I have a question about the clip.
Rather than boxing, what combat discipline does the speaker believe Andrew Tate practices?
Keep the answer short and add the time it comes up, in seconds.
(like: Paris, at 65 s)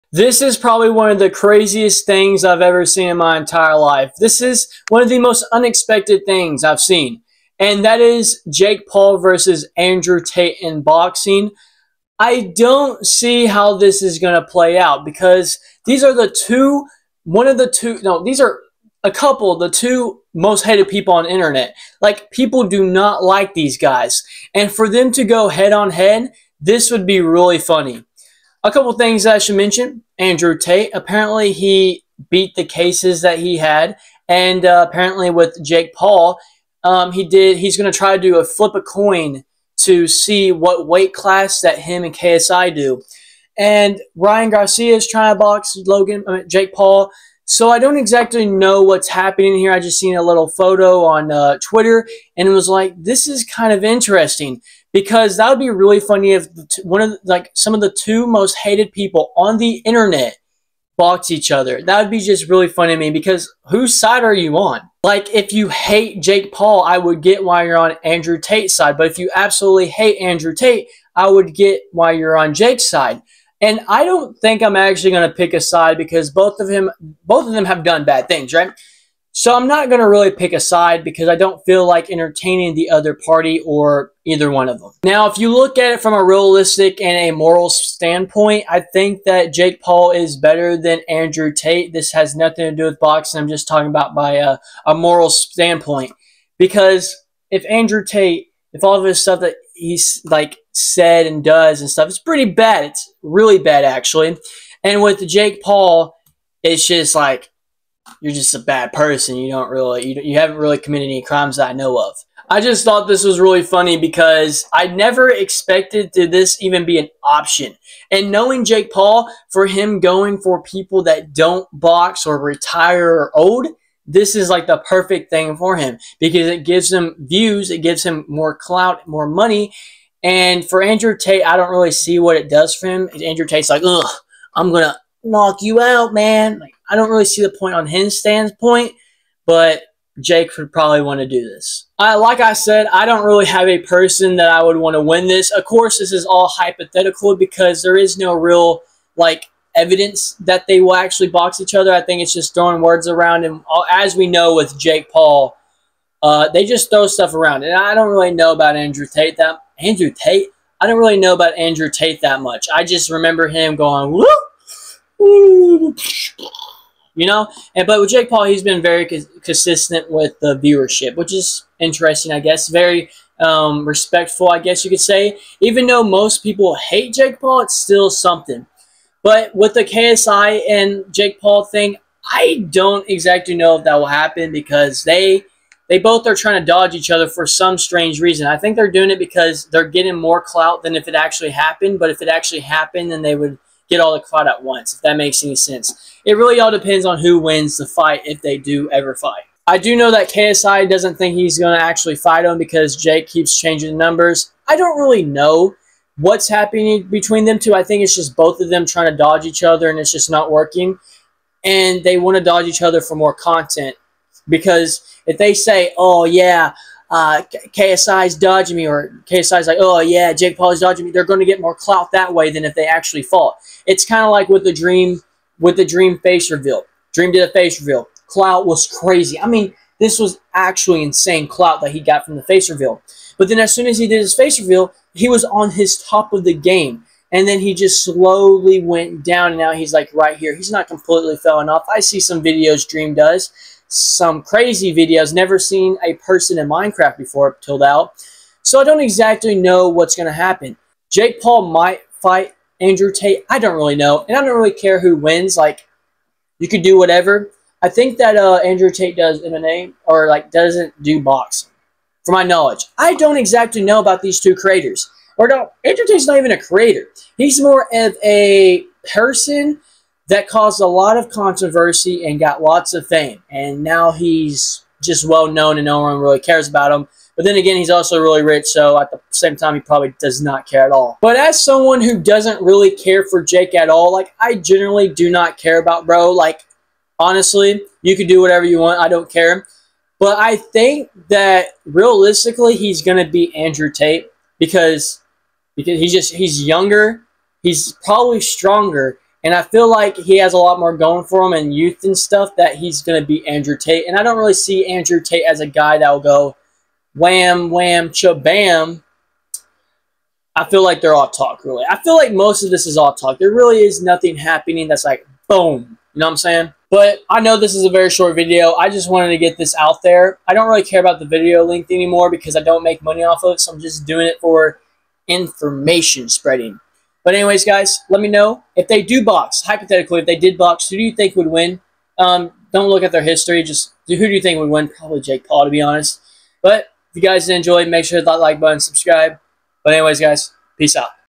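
MMA, at 259 s.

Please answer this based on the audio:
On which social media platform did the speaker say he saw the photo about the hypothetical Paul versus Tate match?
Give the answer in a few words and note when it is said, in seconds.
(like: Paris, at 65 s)
Twitter, at 51 s.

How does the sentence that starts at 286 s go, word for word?
Like, honestly, you can do whatever you want.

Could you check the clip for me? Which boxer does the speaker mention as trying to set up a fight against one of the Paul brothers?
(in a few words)
Ryan Garcia.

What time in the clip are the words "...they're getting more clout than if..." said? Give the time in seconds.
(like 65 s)
189 s.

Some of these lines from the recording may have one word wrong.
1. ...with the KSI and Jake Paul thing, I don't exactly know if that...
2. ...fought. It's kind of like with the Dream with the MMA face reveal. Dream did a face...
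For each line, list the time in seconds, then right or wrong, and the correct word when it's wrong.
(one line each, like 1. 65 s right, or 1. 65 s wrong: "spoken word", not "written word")
1. 179 s right
2. 223 s wrong: "Dream", not "MMA".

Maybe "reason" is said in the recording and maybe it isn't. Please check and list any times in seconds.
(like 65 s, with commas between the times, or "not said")
188 s.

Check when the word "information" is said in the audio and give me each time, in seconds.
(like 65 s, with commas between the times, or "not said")
325 s.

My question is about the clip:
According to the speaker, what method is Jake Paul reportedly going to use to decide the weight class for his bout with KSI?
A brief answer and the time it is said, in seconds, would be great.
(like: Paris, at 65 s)
Flip a coin, at 38 s.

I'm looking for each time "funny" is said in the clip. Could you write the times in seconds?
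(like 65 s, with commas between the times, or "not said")
27 s, 55 s, 62 s, 113 s.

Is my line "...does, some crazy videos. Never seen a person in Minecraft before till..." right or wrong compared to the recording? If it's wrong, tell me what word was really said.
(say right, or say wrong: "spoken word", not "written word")
right.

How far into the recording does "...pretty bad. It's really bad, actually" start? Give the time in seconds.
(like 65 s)
102 s.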